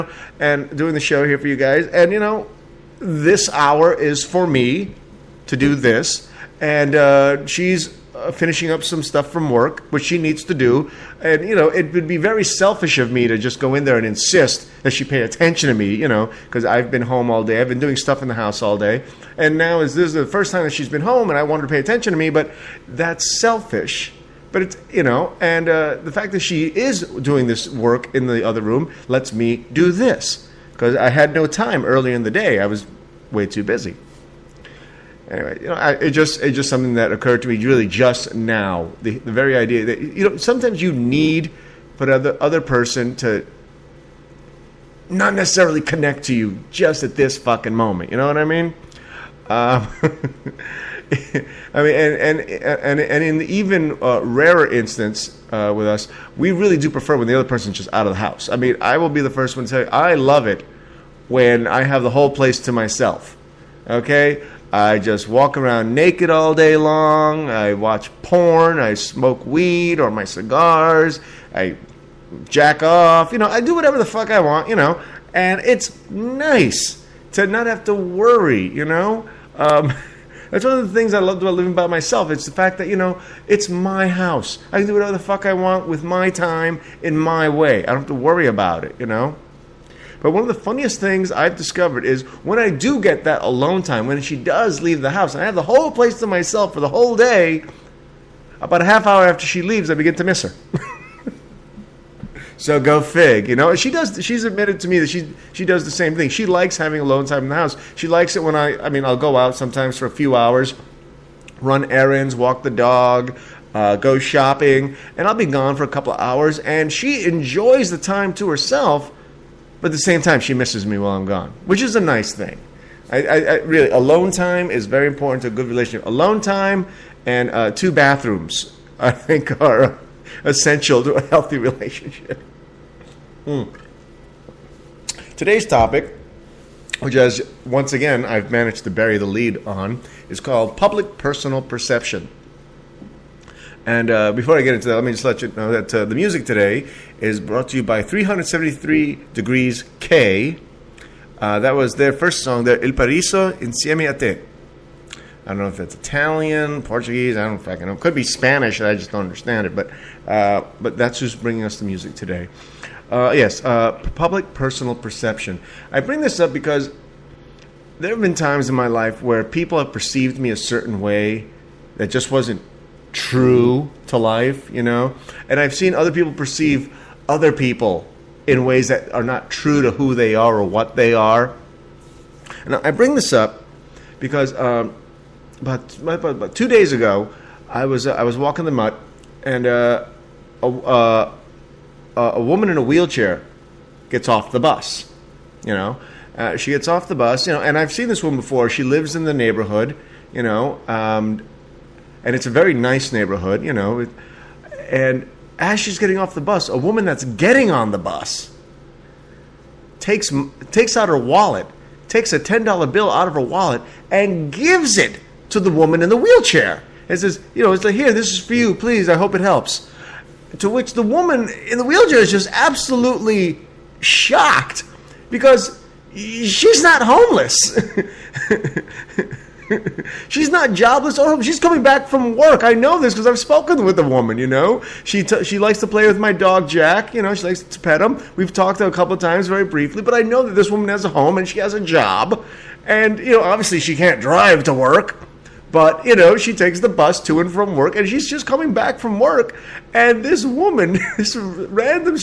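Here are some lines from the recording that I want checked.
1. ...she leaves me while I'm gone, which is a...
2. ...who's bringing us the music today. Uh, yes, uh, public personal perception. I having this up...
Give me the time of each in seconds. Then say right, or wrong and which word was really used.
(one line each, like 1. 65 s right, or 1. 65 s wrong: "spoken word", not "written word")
1. 120 s wrong: "misses", not "leaves"
2. 161 s wrong: "bring", not "having".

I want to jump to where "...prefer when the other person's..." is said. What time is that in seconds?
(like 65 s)
56 s.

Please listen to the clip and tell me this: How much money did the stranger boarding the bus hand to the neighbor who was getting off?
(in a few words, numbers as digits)
$10.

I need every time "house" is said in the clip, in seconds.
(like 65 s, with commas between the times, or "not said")
18 s, 58 s, 84 s, 95 s, 107 s.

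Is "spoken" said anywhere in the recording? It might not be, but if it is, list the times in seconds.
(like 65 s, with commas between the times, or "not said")
233 s.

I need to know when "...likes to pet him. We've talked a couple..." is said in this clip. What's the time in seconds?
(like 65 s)
237 s.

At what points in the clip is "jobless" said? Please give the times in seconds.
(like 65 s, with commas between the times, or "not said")
230 s.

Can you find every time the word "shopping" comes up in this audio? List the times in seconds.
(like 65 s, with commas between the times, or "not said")
114 s.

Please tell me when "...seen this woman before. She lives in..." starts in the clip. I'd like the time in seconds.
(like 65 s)
197 s.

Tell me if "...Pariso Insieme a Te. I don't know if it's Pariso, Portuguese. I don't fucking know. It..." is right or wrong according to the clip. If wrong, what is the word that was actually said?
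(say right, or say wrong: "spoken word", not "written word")
wrong: "Italian", not "Pariso".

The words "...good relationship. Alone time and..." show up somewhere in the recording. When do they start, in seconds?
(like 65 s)
125 s.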